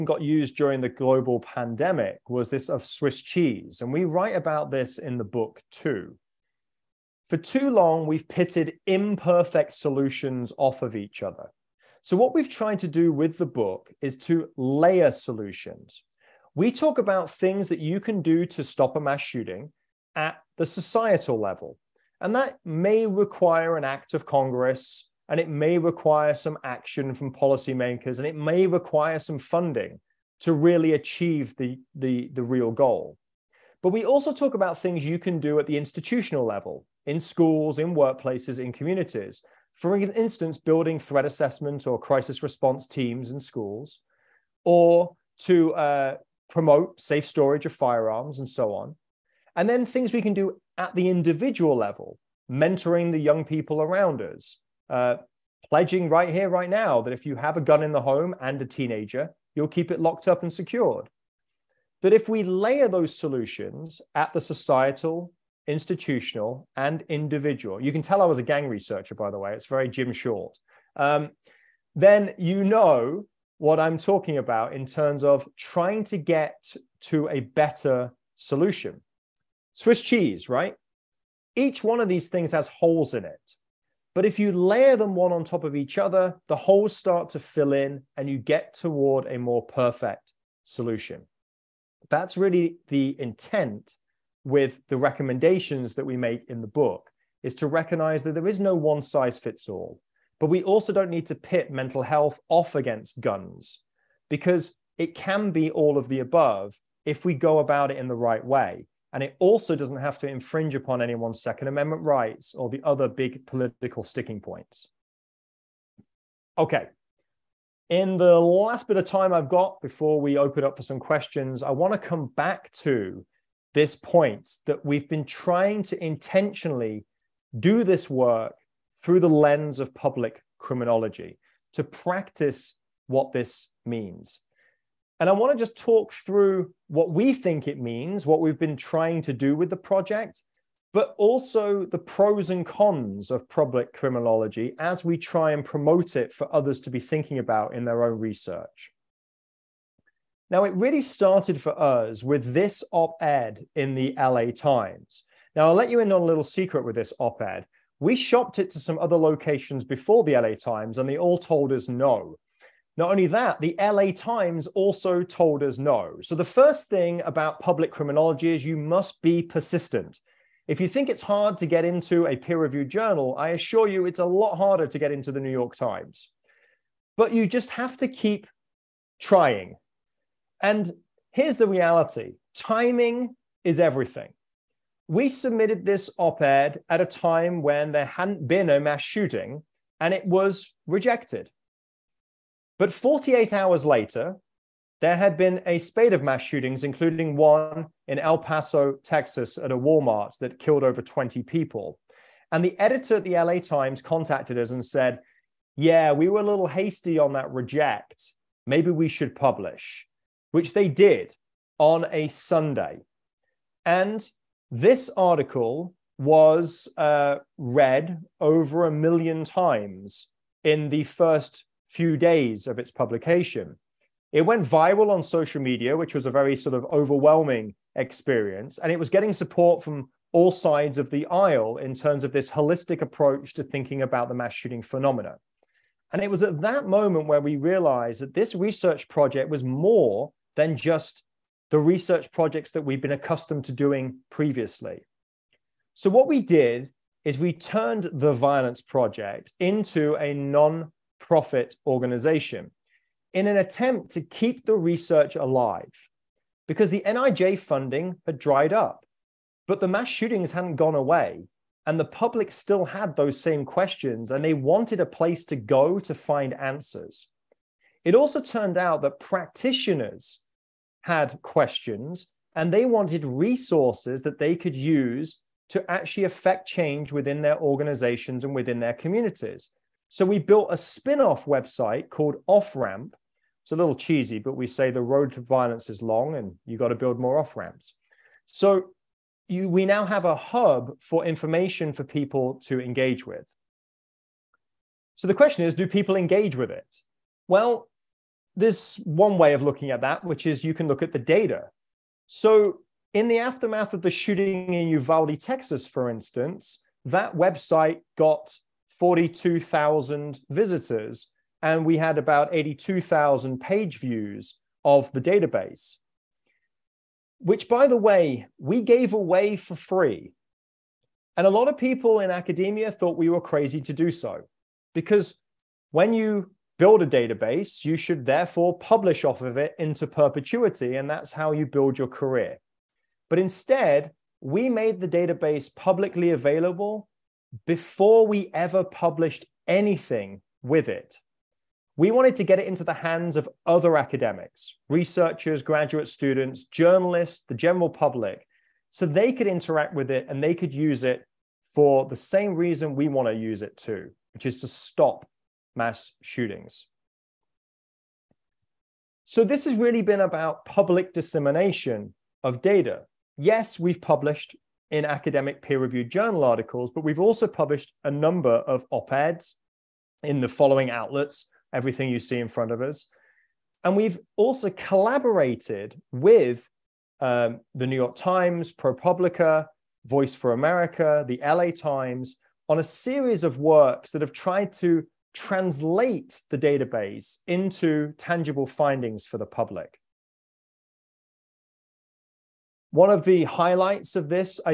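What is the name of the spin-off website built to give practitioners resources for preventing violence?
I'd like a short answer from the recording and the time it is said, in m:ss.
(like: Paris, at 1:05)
Off Ramp, at 4:42.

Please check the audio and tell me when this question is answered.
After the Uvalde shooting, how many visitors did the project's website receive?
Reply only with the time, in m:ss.
5:08.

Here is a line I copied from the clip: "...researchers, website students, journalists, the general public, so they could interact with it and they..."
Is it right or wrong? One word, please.
wrong.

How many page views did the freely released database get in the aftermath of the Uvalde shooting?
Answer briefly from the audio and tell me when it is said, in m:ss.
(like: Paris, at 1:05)
82,000, at 5:12.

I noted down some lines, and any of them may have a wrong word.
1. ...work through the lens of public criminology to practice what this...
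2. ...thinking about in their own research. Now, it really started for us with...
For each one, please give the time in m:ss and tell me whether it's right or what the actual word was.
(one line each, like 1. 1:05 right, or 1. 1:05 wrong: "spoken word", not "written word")
1. 2:08 right
2. 2:26 right.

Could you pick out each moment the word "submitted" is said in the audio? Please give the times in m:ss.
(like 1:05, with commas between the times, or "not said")
3:05.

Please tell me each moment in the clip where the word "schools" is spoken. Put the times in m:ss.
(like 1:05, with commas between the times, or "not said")
0:37, 0:43.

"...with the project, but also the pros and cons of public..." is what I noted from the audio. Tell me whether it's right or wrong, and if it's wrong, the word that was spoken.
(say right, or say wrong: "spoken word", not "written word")
right.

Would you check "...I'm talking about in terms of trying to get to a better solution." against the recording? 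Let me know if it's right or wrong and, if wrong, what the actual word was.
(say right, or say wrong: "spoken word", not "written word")
right.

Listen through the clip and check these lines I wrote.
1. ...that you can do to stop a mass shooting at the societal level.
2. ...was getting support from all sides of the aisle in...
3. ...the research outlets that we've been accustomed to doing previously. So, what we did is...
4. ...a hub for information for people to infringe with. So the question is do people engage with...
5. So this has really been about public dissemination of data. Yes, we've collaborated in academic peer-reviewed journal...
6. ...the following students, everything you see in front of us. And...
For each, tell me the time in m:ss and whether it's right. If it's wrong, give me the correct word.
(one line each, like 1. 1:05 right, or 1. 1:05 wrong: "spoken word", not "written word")
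1. 0:17 right
2. 3:49 right
3. 4:01 wrong: "projects", not "outlets"
4. 4:50 wrong: "engage", not "infringe"
5. 5:59 wrong: "published", not "collaborated"
6. 6:10 wrong: "outlets", not "students".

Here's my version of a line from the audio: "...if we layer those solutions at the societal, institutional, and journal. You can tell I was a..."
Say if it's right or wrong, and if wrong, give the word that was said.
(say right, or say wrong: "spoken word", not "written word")
wrong: "individual", not "journal".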